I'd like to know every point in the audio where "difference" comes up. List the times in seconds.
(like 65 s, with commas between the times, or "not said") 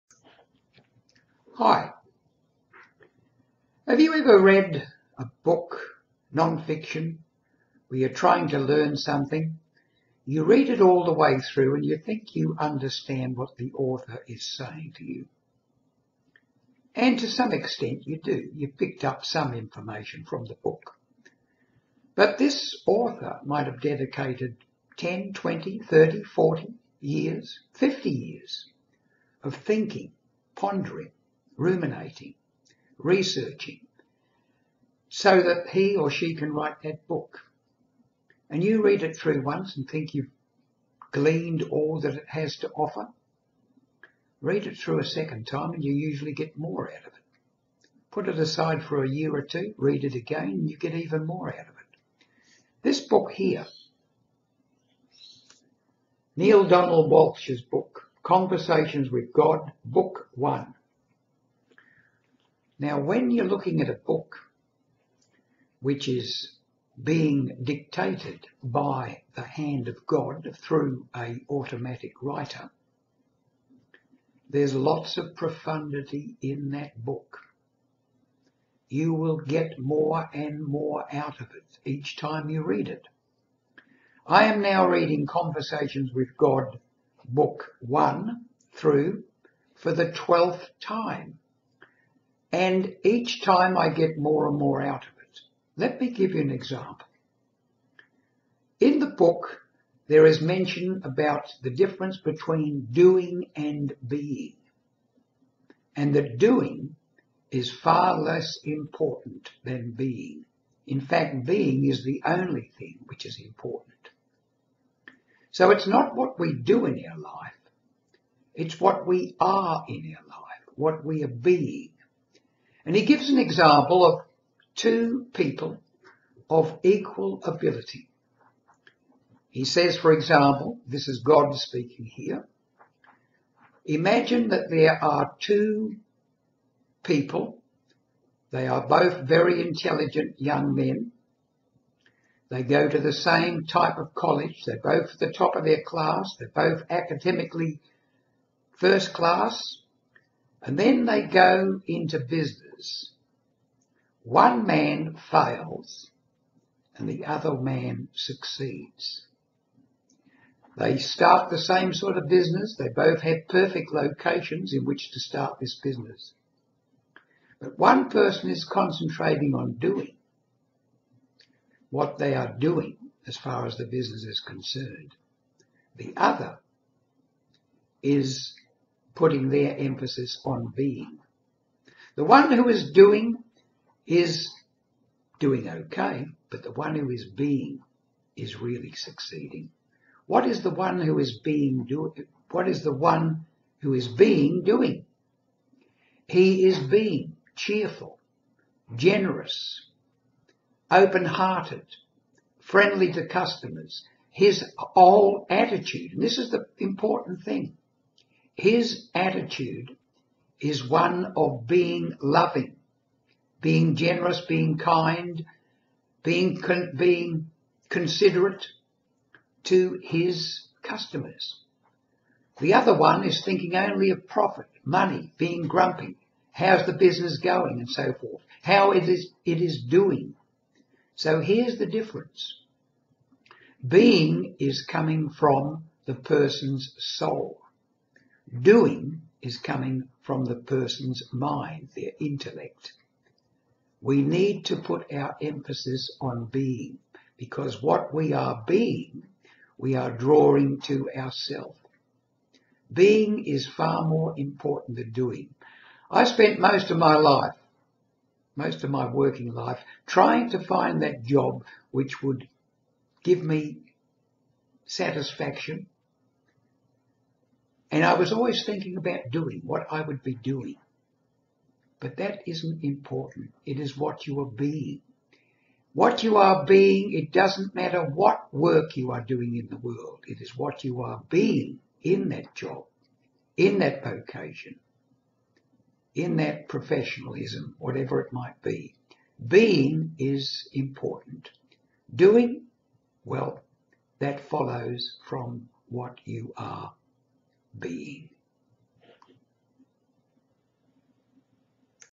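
101 s, 231 s.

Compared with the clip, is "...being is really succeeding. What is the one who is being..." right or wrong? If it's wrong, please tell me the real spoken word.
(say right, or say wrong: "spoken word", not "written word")
right.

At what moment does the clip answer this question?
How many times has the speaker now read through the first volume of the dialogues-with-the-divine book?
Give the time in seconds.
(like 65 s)
90 s.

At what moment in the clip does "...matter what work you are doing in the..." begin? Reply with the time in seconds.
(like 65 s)
277 s.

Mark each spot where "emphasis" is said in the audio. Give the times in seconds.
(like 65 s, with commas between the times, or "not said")
179 s, 245 s.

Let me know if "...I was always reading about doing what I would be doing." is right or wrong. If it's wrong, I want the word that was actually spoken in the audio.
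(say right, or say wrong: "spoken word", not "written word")
wrong: "thinking", not "reading".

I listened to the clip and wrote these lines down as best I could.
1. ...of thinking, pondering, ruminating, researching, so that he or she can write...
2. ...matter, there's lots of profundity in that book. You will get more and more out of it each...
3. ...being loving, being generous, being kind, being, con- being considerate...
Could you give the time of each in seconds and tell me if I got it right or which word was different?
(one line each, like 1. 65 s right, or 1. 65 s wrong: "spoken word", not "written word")
1. 29 s right
2. 72 s wrong: "writer", not "matter"
3. 211 s right.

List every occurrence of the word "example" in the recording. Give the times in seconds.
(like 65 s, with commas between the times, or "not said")
96 s, 123 s, 130 s.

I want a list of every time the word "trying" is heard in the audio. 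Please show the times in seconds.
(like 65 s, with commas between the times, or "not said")
8 s, 260 s.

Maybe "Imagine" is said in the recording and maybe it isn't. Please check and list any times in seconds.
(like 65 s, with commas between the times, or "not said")
133 s.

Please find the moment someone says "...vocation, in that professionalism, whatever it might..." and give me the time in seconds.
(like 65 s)
284 s.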